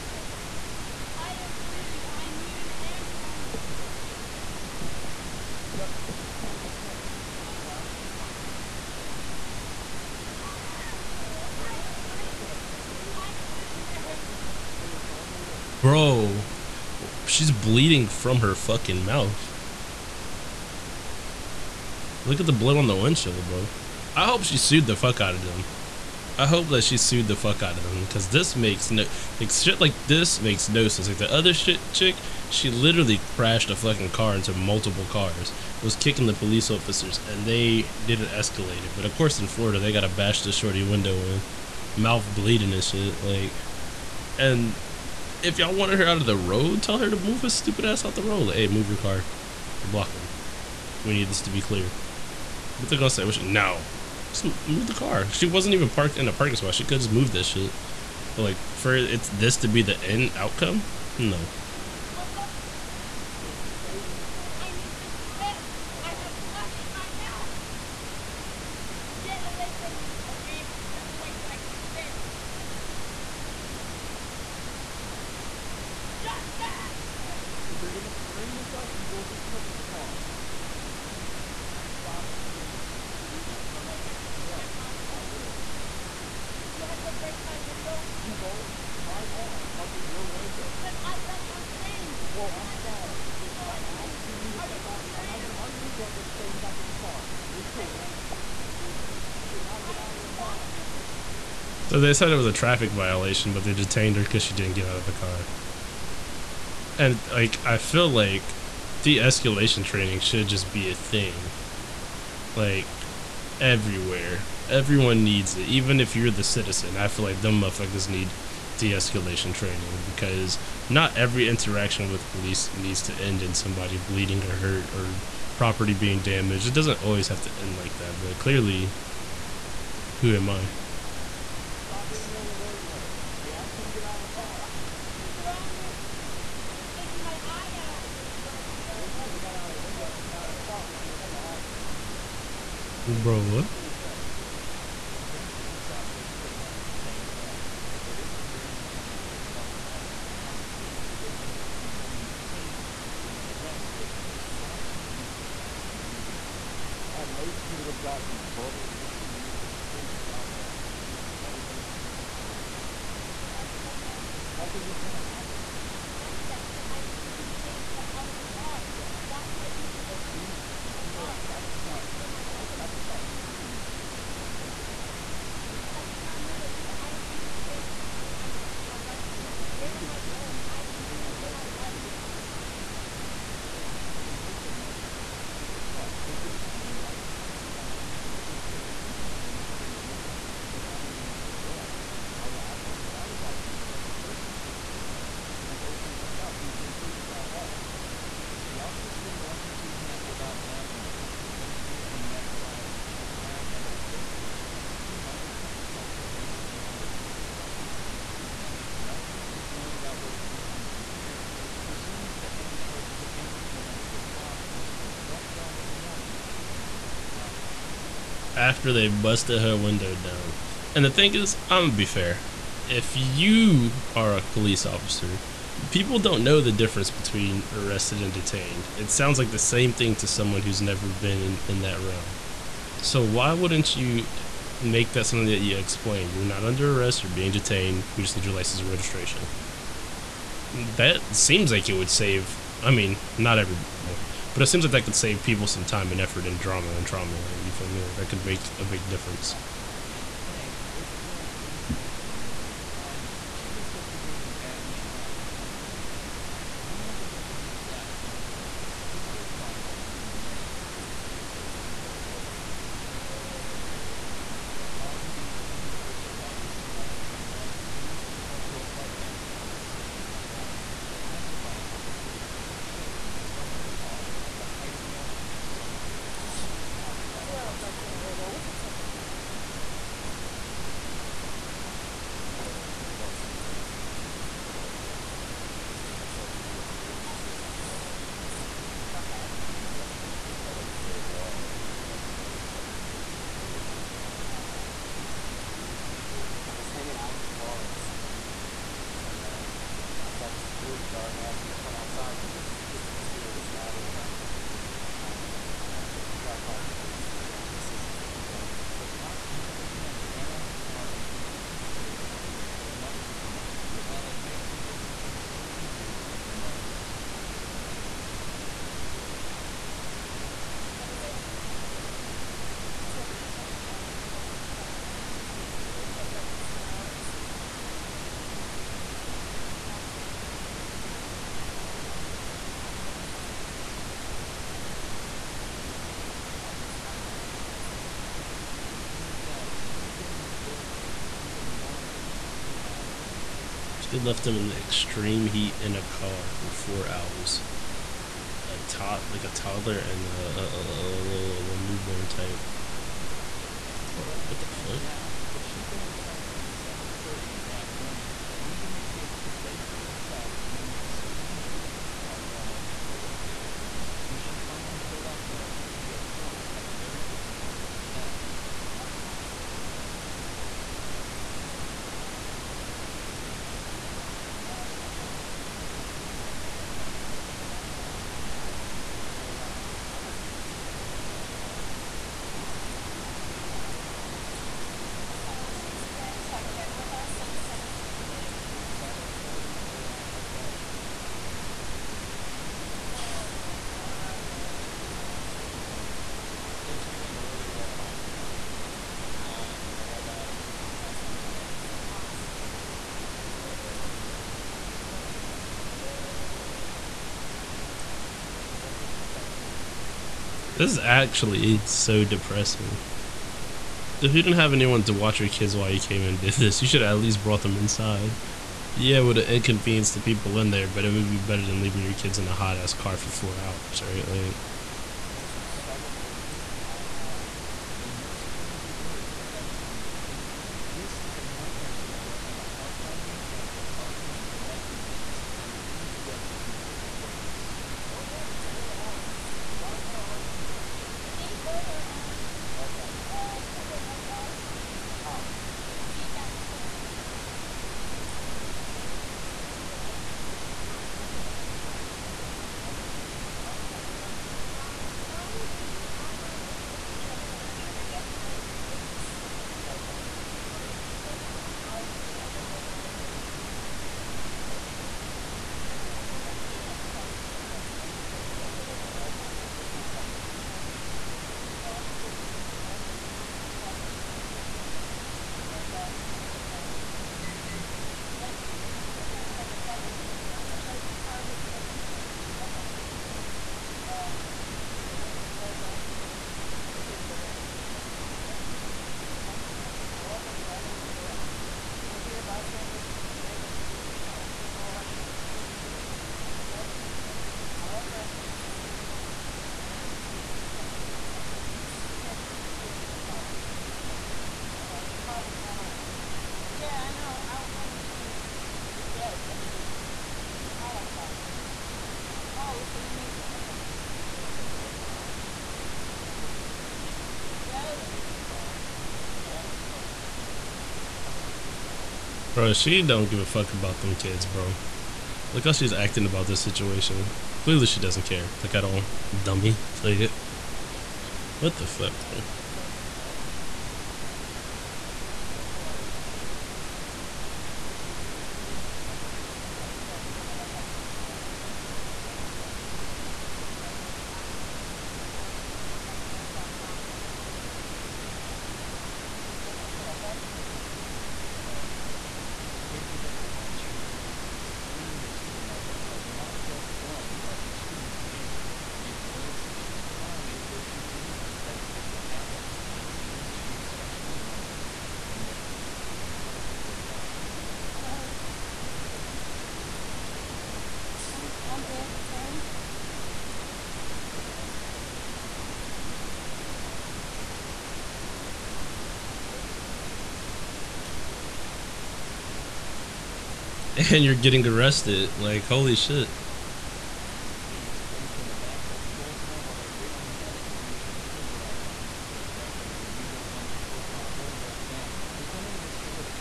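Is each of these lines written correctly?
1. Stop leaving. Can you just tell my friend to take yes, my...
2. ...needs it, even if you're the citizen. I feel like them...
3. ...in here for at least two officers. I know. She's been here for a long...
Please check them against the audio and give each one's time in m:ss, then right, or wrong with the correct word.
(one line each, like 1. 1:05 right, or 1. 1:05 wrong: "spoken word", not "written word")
1. 1:21 wrong: "screaming", not "leaving"
2. 1:55 right
3. 5:25 wrong: "hours", not "officers".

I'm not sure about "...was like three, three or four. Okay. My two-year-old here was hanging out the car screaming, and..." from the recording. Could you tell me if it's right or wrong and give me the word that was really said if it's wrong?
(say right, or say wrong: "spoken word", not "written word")
right.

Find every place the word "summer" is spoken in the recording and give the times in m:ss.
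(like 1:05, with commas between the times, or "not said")
4:35.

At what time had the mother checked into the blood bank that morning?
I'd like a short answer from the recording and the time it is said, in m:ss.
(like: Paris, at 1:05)
7:30, at 6:49.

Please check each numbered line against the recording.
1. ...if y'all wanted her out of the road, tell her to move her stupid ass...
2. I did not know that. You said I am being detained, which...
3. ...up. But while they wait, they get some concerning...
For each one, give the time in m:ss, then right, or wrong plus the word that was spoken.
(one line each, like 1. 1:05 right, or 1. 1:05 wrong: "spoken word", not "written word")
1. 0:45 right
2. 2:55 right
3. 5:13 right.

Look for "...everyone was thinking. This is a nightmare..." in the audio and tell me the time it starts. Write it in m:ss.
7:09.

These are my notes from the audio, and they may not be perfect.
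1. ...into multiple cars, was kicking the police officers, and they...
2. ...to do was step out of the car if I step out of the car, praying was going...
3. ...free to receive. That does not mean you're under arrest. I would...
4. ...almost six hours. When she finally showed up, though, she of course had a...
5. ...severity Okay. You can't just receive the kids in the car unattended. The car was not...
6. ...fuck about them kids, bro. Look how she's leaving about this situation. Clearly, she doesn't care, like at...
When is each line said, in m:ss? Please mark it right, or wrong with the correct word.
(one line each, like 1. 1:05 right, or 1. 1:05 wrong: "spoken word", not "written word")
1. 0:34 right
2. 2:41 wrong: "nothing", not "praying"
3. 3:09 wrong: "leave", not "receive"
4. 6:02 wrong: "four", not "six"
5. 8:19 wrong: "leave", not "receive"
6. 8:43 wrong: "acting", not "leaving".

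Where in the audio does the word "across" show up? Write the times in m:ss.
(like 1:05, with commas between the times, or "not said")
3:25.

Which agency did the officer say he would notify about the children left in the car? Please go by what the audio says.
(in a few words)
Child Family Services.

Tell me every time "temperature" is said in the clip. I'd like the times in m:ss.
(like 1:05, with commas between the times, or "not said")
4:38, 8:59.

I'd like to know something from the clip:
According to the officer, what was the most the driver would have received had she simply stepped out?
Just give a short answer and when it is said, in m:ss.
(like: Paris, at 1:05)
A verbal warning, at 2:38.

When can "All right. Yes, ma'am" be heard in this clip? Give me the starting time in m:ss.
8:08.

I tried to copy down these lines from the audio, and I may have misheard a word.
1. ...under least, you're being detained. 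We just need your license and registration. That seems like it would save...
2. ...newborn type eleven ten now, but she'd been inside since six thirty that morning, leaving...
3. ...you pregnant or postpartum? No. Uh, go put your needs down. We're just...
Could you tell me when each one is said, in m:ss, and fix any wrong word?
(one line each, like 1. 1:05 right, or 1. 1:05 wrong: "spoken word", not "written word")
1. 3:56 wrong: "arrest", not "least"
2. 5:51 wrong: "seven", not "six"
3. 9:26 wrong: "hands", not "needs".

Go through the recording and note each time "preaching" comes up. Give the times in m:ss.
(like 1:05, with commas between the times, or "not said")
not said.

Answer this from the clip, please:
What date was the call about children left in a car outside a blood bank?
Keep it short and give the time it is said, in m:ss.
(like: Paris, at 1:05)
21 August 2021, at 4:25.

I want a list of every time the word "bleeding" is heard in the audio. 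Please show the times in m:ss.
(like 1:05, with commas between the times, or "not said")
0:01, 0:11, 0:17, 0:42, 2:03.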